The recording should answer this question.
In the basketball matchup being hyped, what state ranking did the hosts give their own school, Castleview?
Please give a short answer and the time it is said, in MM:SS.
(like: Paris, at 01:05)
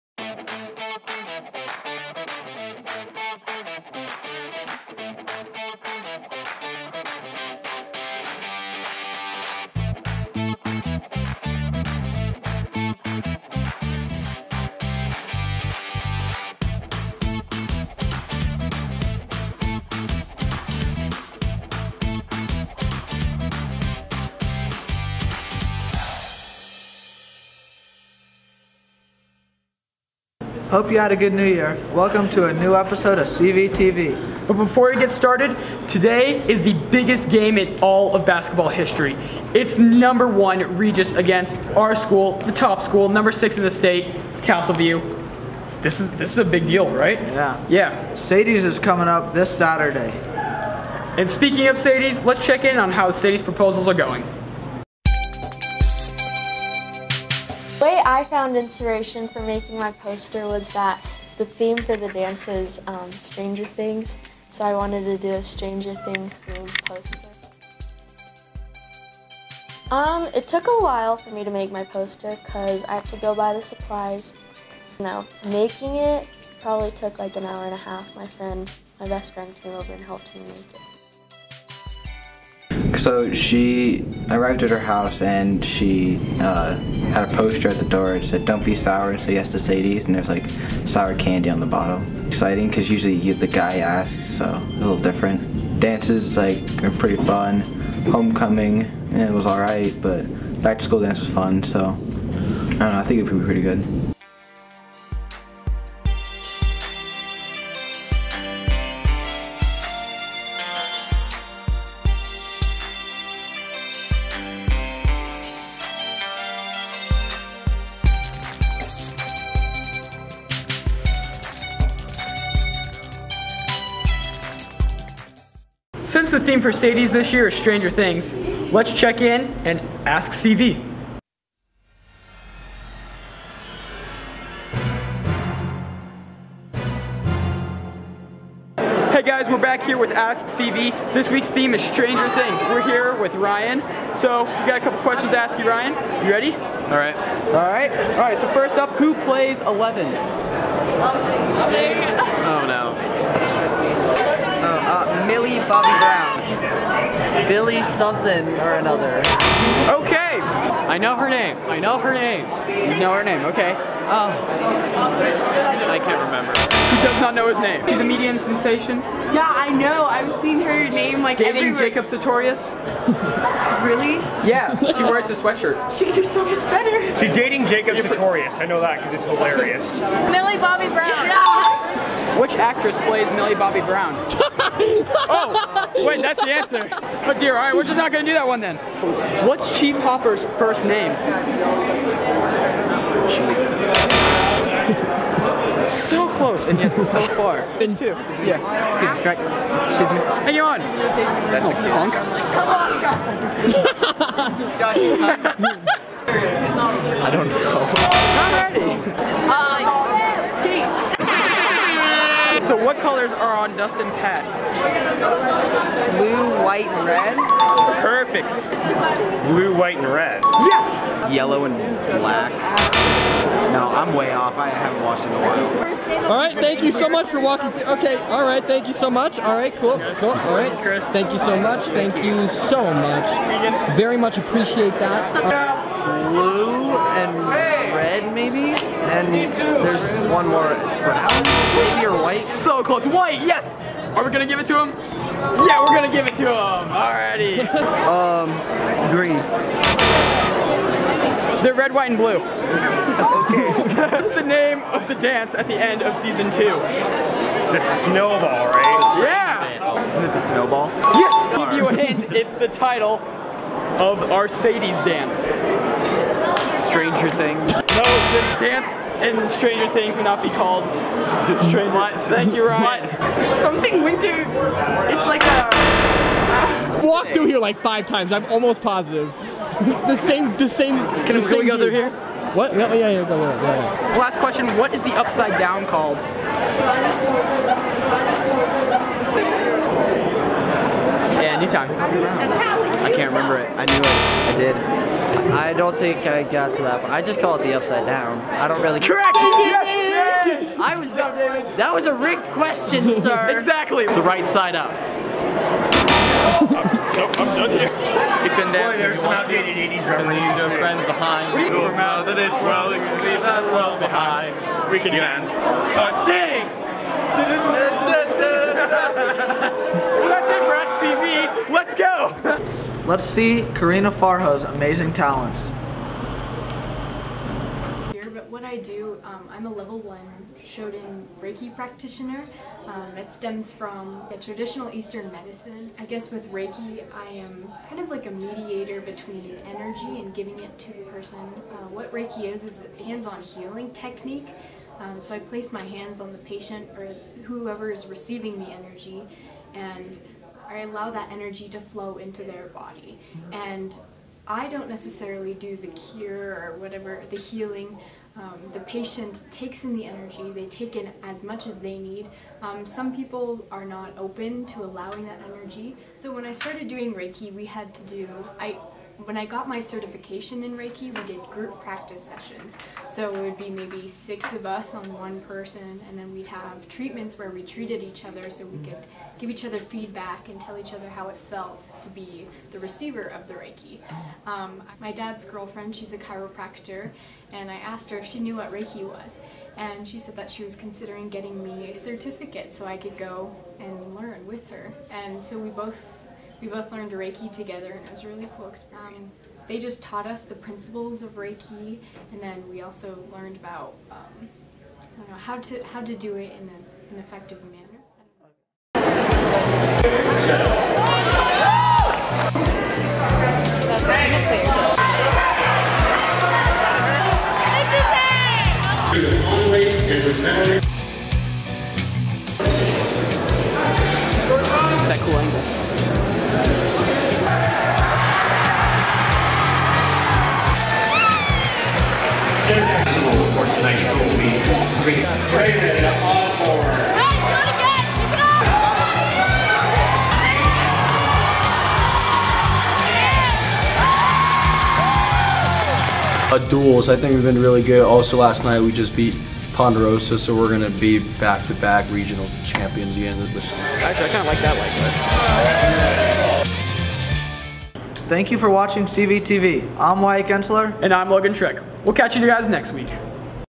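6, at 00:43.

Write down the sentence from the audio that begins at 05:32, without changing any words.
Um, it stems from traditional Eastern medicine.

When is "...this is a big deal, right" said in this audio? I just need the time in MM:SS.
00:46.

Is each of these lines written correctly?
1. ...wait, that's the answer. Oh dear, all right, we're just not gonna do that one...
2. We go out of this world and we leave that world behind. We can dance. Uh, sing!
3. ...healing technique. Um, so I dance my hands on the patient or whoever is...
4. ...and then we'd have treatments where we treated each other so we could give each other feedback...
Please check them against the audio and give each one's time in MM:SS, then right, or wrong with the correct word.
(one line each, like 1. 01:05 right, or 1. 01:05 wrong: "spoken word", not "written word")
1. 03:05 right
2. 05:11 right
3. 05:43 wrong: "place", not "dance"
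4. 06:16 right.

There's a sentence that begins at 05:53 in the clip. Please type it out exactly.
And I don't necessarily do the cure or whatever, the healing.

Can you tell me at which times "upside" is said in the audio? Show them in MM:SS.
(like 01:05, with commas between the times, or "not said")
04:45, 04:57.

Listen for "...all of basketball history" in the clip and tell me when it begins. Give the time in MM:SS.
00:37.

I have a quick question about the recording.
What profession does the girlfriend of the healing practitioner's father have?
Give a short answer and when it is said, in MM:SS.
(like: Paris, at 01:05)
Chiropractor, at 06:26.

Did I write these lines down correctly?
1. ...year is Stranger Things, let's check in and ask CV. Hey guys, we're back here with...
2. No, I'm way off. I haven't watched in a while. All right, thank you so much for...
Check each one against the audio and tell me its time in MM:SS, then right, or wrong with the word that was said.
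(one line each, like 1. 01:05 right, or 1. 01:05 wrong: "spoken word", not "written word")
1. 02:07 right
2. 03:43 right.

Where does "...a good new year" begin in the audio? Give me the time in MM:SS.
00:31.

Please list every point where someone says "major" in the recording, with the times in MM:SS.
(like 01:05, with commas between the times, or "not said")
not said.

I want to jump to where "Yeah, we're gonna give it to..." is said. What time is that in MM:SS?
04:04.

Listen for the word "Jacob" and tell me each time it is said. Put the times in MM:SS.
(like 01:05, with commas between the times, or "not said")
02:51, 02:57.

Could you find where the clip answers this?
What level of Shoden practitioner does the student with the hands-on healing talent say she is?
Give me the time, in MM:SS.
05:29.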